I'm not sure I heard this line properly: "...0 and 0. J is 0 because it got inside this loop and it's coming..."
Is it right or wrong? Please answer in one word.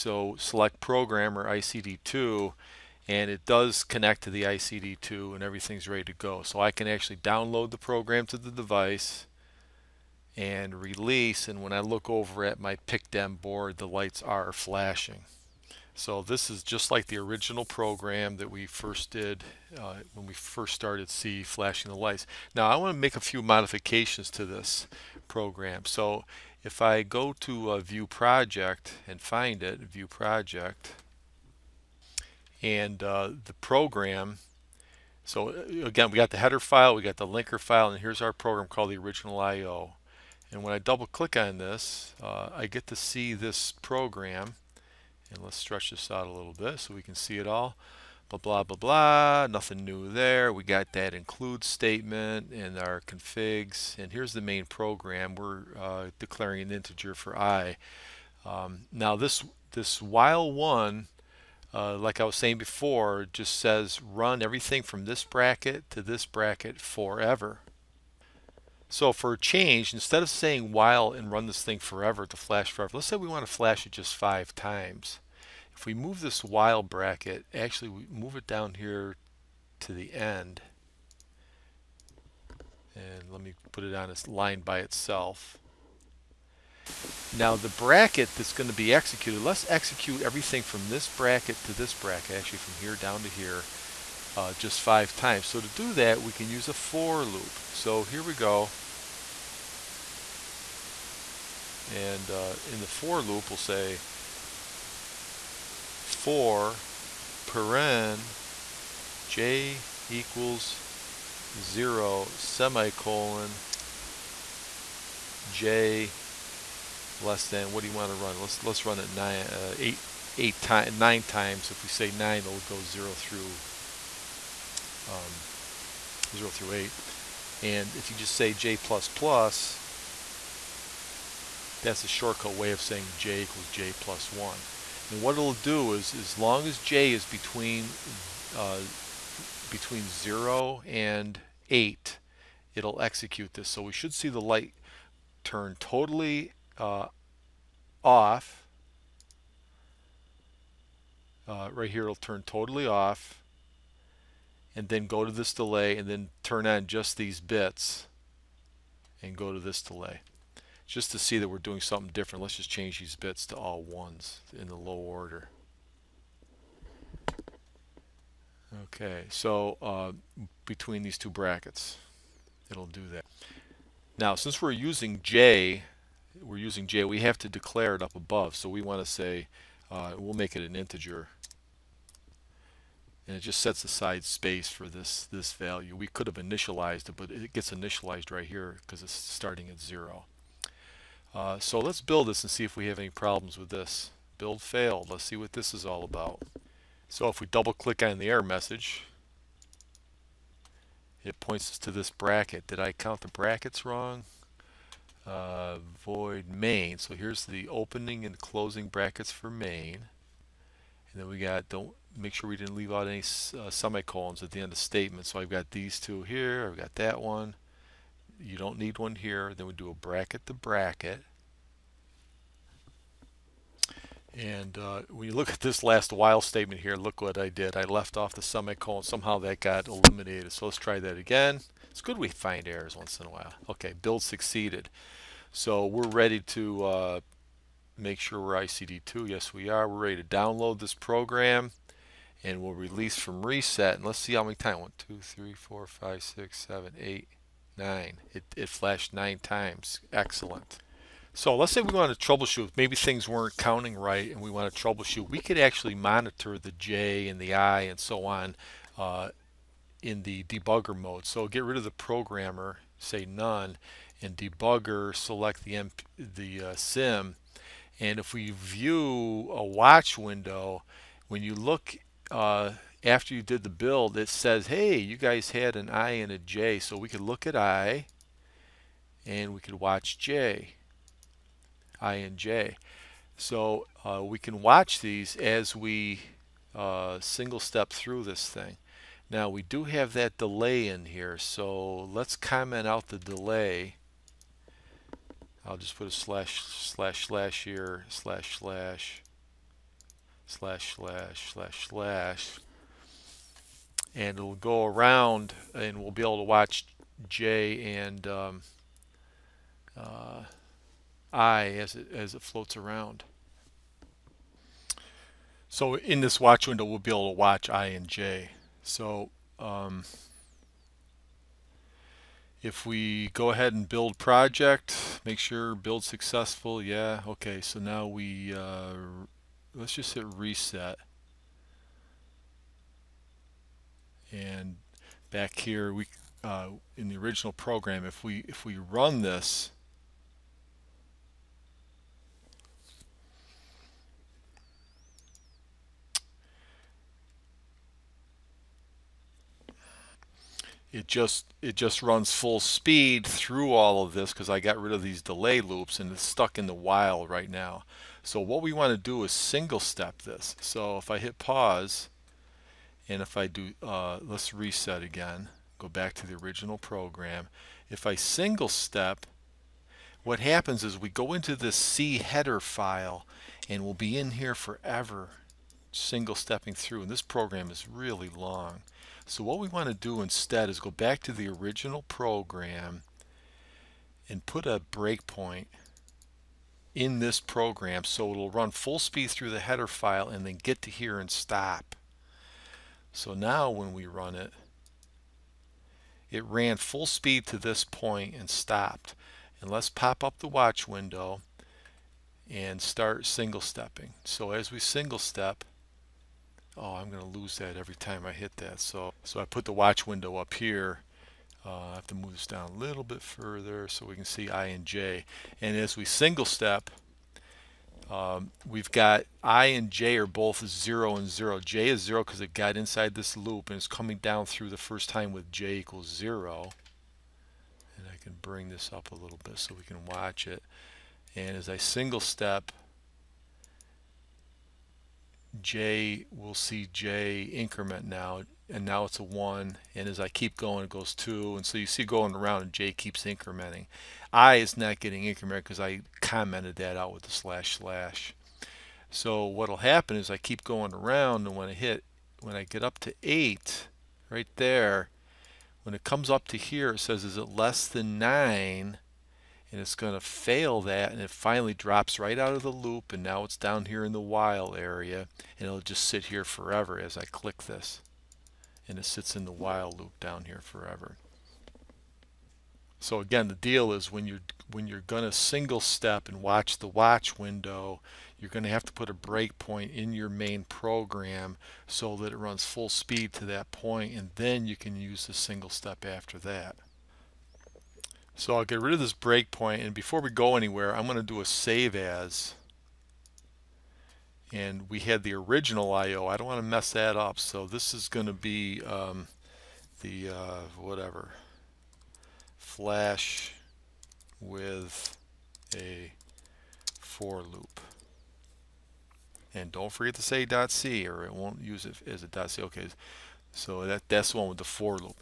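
right.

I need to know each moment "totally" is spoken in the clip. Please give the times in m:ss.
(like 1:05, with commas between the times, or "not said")
2:25, 2:32.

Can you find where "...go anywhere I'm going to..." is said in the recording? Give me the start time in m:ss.
8:10.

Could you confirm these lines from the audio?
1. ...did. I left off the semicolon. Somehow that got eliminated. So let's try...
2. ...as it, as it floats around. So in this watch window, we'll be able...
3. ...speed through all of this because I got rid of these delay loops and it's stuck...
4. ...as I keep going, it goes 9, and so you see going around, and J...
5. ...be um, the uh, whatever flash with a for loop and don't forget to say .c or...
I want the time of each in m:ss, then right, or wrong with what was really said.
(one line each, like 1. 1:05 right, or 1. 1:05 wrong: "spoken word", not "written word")
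1. 3:47 right
2. 5:11 right
3. 5:52 right
4. 7:20 wrong: "2", not "9"
5. 8:18 right.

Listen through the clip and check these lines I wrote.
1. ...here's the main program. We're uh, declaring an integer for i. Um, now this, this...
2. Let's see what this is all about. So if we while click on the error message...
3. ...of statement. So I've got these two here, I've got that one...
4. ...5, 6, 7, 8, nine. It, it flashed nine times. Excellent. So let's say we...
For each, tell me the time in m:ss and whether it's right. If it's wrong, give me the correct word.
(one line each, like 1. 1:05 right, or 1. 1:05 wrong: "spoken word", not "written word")
1. 0:54 right
2. 3:15 wrong: "double", not "while"
3. 3:34 right
4. 4:07 right.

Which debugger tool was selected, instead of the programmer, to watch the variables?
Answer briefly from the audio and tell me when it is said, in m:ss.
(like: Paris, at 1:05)
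sim, at 4:26.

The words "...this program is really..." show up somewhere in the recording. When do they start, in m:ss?
6:17.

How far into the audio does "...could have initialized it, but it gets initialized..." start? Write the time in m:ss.
3:06.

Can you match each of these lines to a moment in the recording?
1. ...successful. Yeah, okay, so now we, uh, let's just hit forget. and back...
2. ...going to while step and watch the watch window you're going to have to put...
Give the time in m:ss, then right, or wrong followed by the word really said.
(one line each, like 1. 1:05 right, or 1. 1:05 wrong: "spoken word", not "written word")
1. 5:26 wrong: "reset", not "forget"
2. 7:55 wrong: "single", not "while".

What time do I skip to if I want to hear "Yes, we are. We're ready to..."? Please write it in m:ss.
3:59.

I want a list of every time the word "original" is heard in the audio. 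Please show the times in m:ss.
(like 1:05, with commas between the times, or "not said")
0:17, 0:38, 5:37, 6:06, 6:21, 8:15.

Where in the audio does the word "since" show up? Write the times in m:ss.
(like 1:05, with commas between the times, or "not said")
2:54.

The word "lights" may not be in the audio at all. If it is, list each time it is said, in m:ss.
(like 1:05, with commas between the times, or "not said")
0:13, 0:21, 2:24.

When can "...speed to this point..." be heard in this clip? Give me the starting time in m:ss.
6:37.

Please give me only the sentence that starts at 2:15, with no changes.
And what it'll do is, as long as j is between uh, between 0 and 8, it'll execute this.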